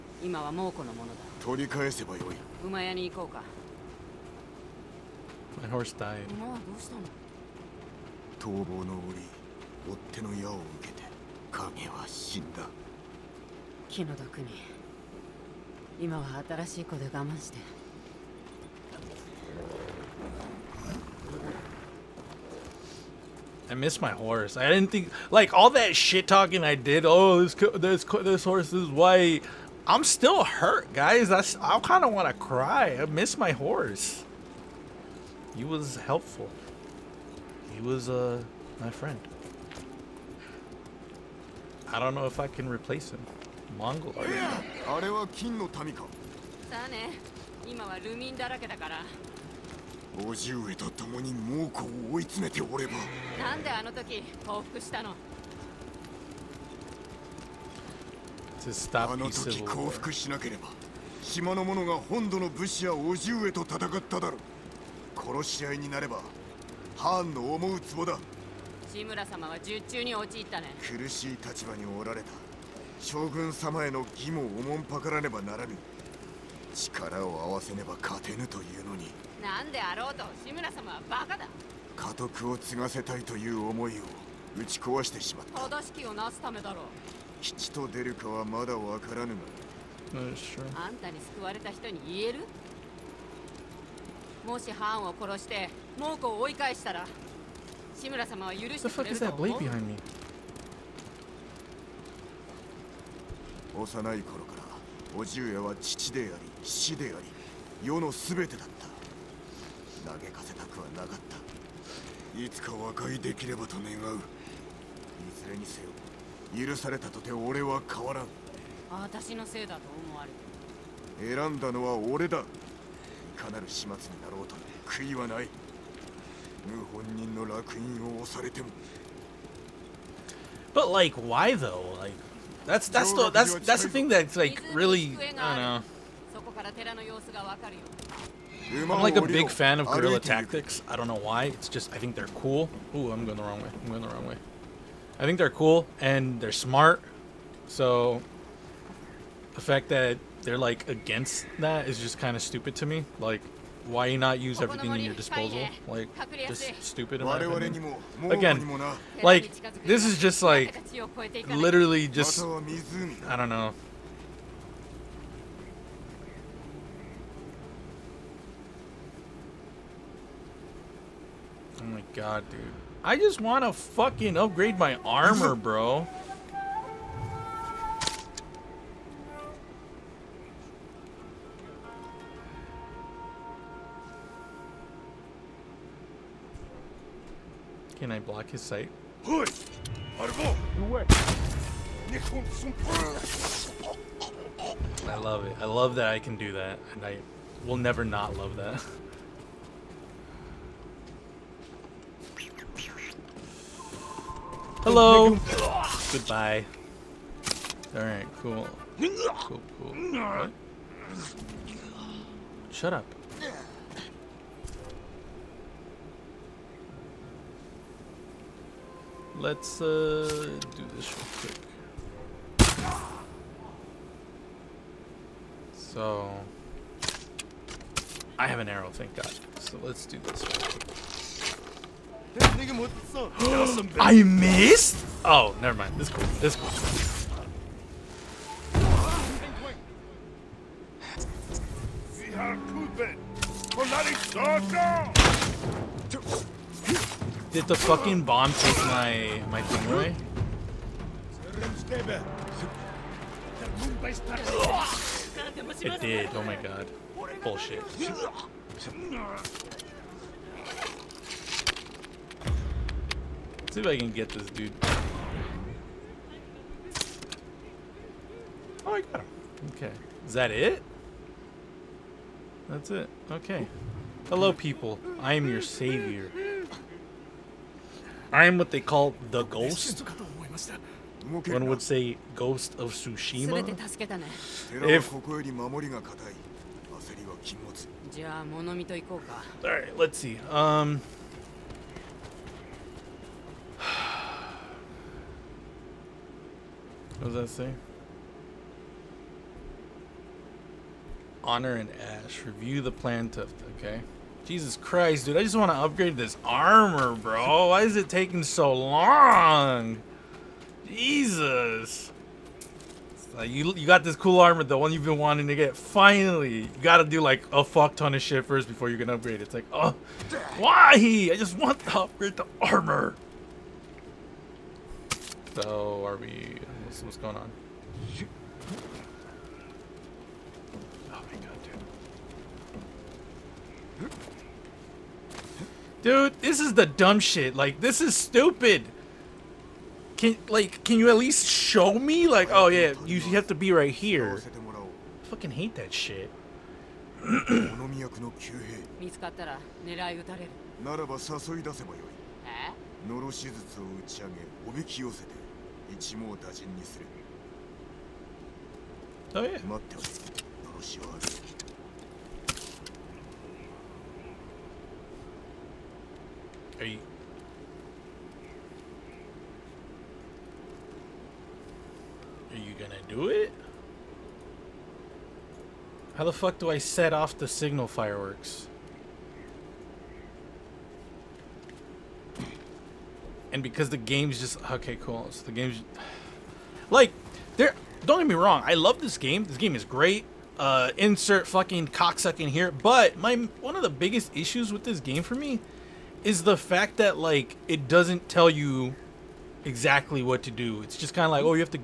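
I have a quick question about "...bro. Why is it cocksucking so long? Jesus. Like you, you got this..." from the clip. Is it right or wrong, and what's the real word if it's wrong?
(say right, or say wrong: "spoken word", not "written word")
wrong: "taking", not "cocksucking".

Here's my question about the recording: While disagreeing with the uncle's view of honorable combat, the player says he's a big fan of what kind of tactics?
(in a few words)
guerrilla.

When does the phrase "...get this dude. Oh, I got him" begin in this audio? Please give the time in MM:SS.
04:24.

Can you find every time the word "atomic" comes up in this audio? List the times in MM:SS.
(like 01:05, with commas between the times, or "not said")
not said.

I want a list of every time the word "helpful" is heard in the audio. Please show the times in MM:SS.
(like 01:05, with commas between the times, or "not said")
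00:35.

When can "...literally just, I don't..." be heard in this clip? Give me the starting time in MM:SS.
02:41.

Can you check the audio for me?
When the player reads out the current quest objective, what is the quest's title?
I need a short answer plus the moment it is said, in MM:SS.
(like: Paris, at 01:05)
Honor and Ash, at 05:01.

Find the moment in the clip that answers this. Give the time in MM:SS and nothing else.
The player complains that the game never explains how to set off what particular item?
06:17.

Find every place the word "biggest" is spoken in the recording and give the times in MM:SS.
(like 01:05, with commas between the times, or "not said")
06:33.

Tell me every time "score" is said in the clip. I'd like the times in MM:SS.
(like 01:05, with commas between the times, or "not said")
not said.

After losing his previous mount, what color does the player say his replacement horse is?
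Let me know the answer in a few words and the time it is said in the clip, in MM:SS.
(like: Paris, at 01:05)
white, at 00:28.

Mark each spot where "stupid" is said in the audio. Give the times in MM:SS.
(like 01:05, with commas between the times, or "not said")
02:32, 02:36, 05:38.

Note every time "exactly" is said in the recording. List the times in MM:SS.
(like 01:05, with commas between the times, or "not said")
06:39.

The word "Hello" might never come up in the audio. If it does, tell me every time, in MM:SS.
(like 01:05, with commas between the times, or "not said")
03:24, 04:34.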